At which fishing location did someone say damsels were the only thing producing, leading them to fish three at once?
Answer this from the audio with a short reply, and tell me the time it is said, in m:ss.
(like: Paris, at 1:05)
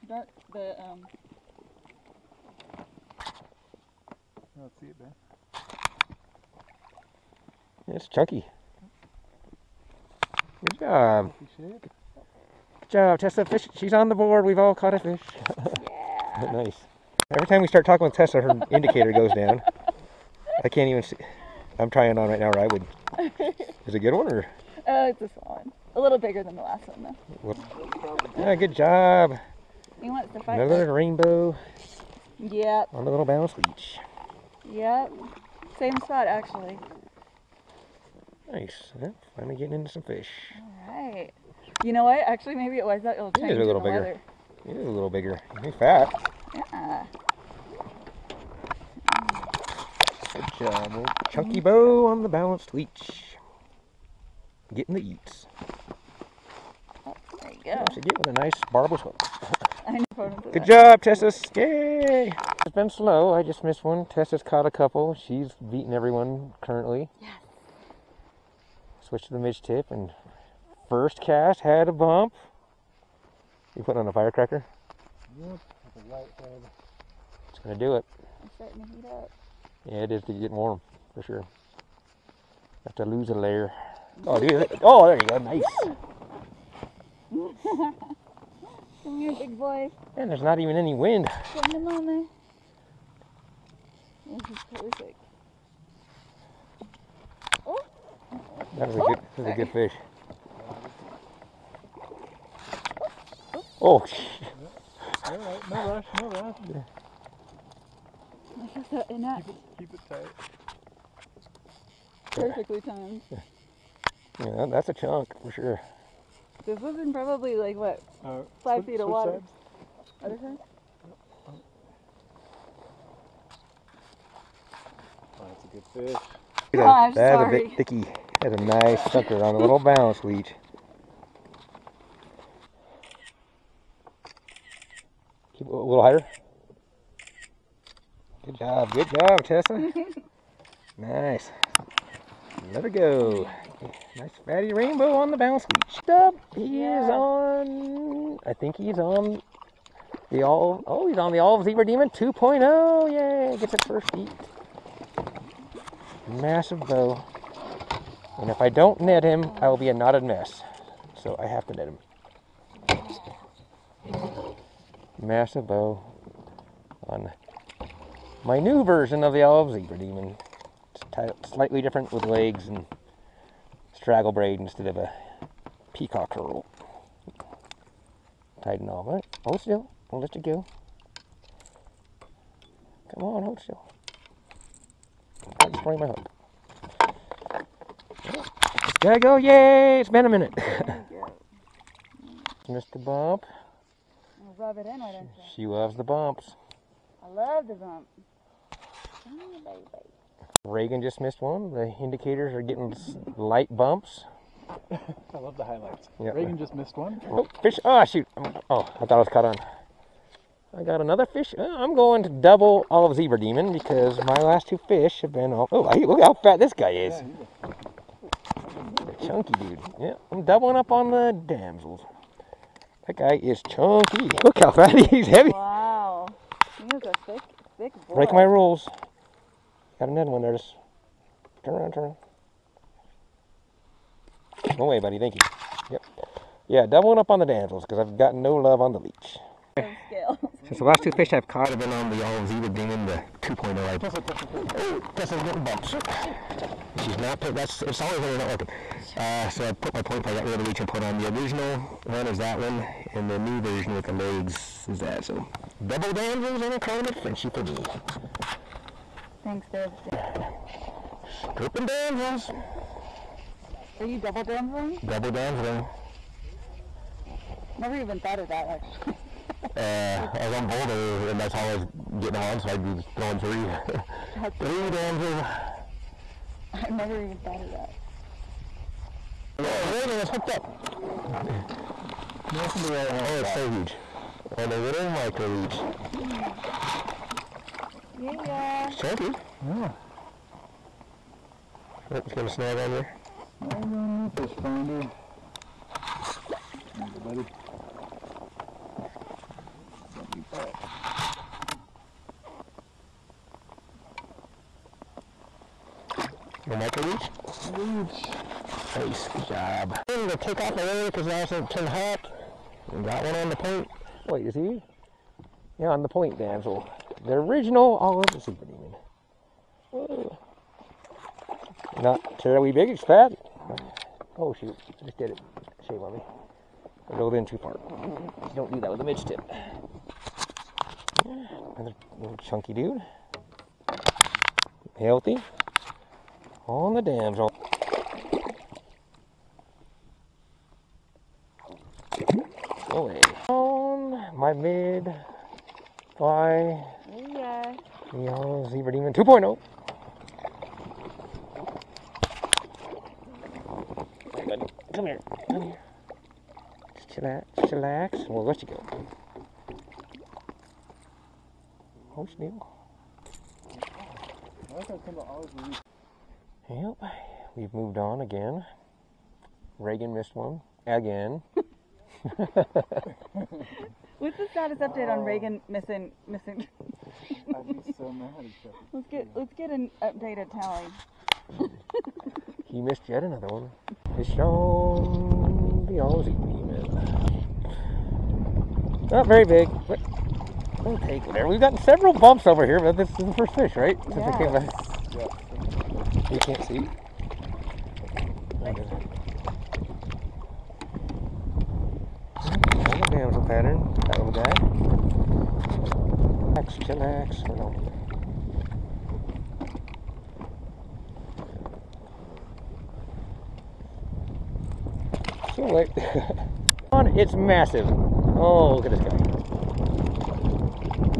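Boulder, at 4:30.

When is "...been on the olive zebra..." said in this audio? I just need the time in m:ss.
4:01.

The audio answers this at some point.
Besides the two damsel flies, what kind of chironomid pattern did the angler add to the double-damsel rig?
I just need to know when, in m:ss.
4:16.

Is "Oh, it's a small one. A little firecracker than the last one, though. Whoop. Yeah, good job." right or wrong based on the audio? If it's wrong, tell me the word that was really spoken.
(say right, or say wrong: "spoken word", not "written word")
wrong: "bigger", not "firecracker".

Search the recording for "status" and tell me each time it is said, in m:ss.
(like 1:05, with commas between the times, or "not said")
6:14.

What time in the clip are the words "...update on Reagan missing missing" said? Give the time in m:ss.
6:14.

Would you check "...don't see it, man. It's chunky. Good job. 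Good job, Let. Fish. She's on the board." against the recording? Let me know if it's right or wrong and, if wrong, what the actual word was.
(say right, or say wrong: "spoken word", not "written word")
wrong: "Tessa", not "Let".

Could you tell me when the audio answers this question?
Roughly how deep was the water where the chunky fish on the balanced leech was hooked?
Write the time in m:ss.
1:58.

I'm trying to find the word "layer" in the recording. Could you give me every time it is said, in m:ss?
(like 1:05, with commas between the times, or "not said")
1:23, 5:10.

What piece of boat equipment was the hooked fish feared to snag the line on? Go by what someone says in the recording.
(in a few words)
fish finder.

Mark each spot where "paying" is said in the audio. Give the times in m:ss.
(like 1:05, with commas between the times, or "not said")
4:07.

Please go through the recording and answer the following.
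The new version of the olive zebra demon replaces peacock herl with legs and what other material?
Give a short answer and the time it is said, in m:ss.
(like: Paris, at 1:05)
straggle braid, at 2:53.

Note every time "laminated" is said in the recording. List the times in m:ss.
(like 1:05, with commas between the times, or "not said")
not said.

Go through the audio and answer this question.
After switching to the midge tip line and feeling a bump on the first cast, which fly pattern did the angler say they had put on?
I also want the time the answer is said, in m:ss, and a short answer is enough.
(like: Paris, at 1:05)
firecracker, at 1:14.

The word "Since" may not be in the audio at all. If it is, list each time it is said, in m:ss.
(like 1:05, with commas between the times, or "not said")
4:00, 6:34.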